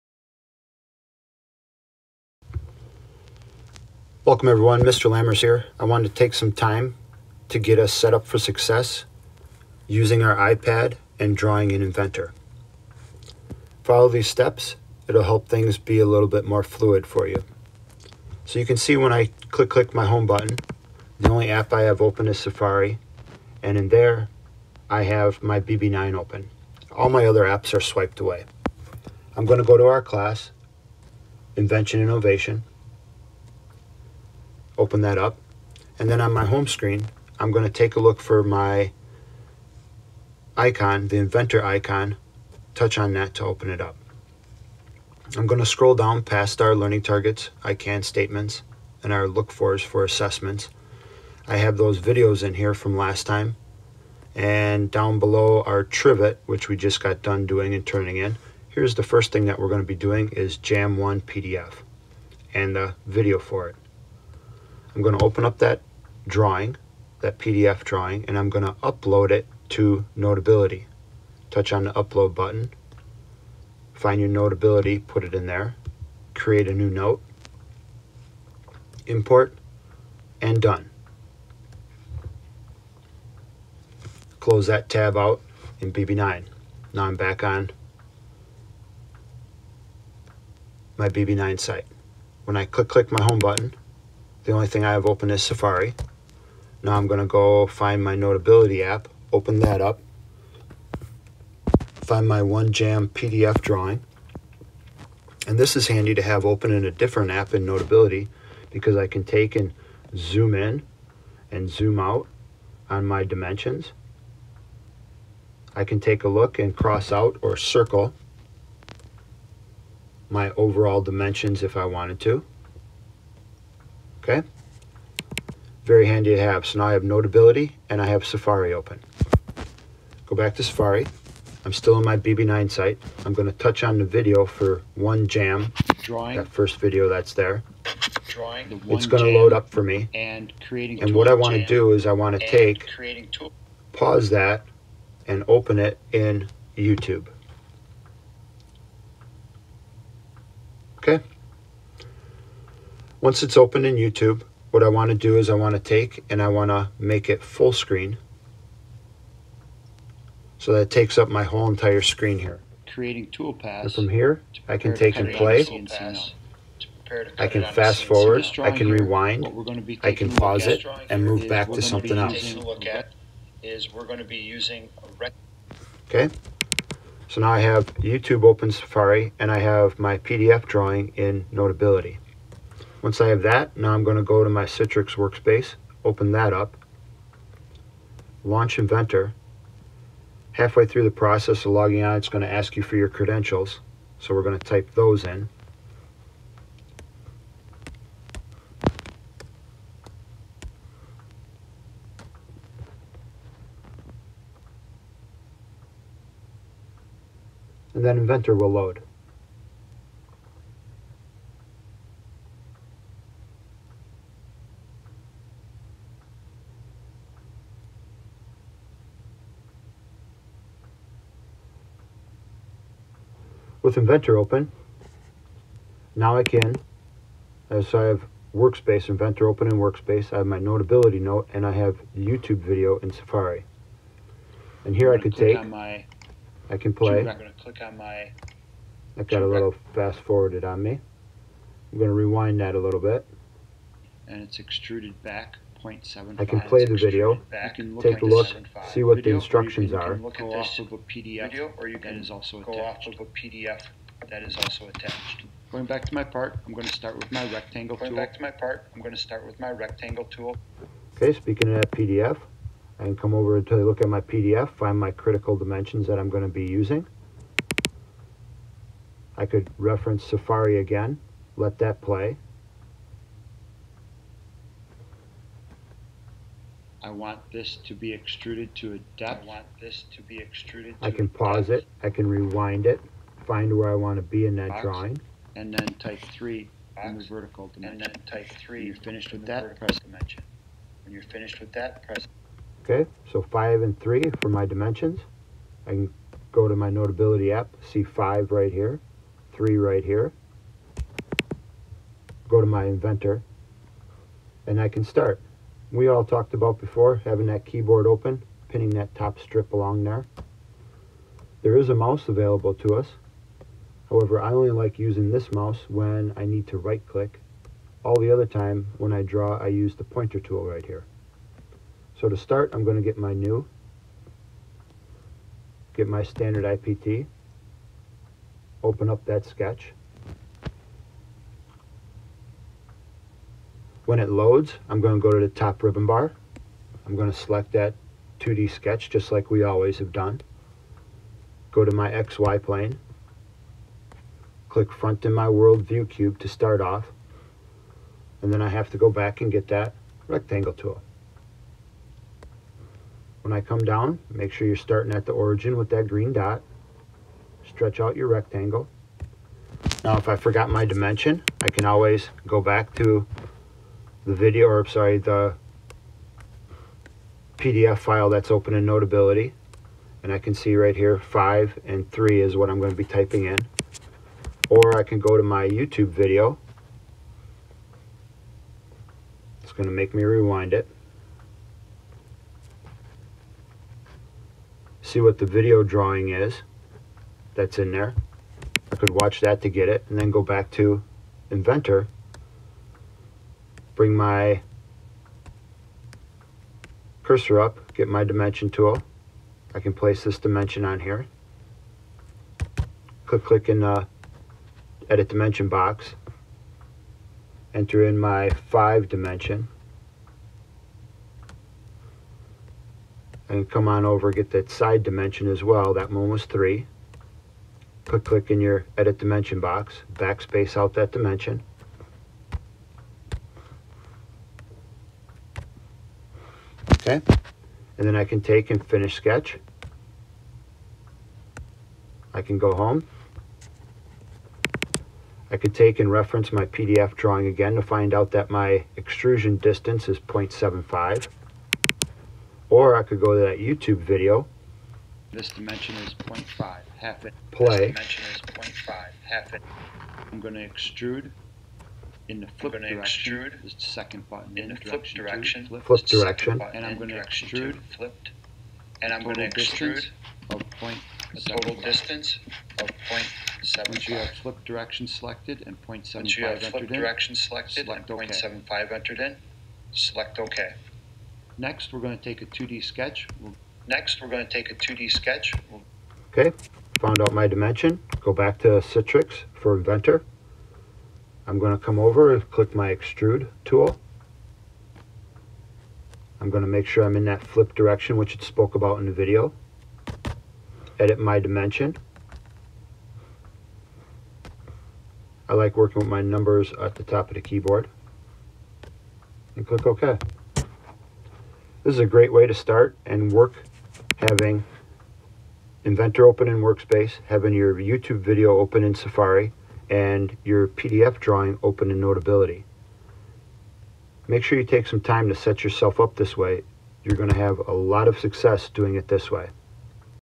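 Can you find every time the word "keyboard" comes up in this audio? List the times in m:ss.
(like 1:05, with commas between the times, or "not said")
5:07, 8:17.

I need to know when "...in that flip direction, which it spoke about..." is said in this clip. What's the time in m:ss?
8:07.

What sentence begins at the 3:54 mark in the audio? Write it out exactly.
And here I could take, my, I can play.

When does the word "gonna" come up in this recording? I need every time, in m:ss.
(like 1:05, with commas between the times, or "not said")
2:13, 2:19.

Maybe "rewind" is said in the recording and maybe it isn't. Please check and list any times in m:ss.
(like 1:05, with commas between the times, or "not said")
2:48, 4:02, 4:42, 6:20.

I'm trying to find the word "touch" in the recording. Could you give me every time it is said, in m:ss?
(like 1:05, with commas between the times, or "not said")
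0:42, 1:11, 2:13.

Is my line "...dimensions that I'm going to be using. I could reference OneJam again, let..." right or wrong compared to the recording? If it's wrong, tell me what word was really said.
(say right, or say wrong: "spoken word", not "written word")
wrong: "Safari", not "OneJam".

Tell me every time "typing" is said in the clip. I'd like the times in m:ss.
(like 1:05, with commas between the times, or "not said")
6:13.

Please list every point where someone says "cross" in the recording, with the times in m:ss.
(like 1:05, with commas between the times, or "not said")
1:56.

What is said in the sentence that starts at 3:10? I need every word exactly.
Halfway through the process of logging on, it's going to ask you for your credentials.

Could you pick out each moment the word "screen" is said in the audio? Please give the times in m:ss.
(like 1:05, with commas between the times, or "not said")
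0:36, 2:37, 2:42.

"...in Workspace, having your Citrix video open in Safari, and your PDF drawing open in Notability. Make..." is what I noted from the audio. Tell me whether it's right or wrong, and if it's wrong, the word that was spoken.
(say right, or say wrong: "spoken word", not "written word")
wrong: "YouTube", not "Citrix".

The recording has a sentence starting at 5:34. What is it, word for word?
When it loads, I'm going to go to the top ribbon bar.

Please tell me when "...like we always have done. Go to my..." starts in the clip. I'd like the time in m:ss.
5:39.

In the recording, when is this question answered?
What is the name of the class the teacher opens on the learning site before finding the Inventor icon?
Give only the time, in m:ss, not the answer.
0:31.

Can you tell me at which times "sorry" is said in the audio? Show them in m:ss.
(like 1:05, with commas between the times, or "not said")
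6:04.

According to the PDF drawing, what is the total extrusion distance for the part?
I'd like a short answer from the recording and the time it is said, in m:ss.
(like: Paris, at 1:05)
0.75, at 7:20.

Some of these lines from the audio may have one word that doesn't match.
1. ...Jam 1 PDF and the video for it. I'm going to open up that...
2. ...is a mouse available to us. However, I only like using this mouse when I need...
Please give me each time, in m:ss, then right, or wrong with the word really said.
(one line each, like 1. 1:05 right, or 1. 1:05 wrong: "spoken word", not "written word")
1. 1:00 right
2. 5:11 right.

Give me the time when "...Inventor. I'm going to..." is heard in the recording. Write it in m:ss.
7:59.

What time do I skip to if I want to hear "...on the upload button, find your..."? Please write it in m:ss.
1:11.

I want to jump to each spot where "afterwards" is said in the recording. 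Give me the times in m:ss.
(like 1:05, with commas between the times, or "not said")
not said.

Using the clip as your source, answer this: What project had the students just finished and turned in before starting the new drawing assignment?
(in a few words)
trivet.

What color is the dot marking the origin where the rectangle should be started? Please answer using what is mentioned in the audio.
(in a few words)
green.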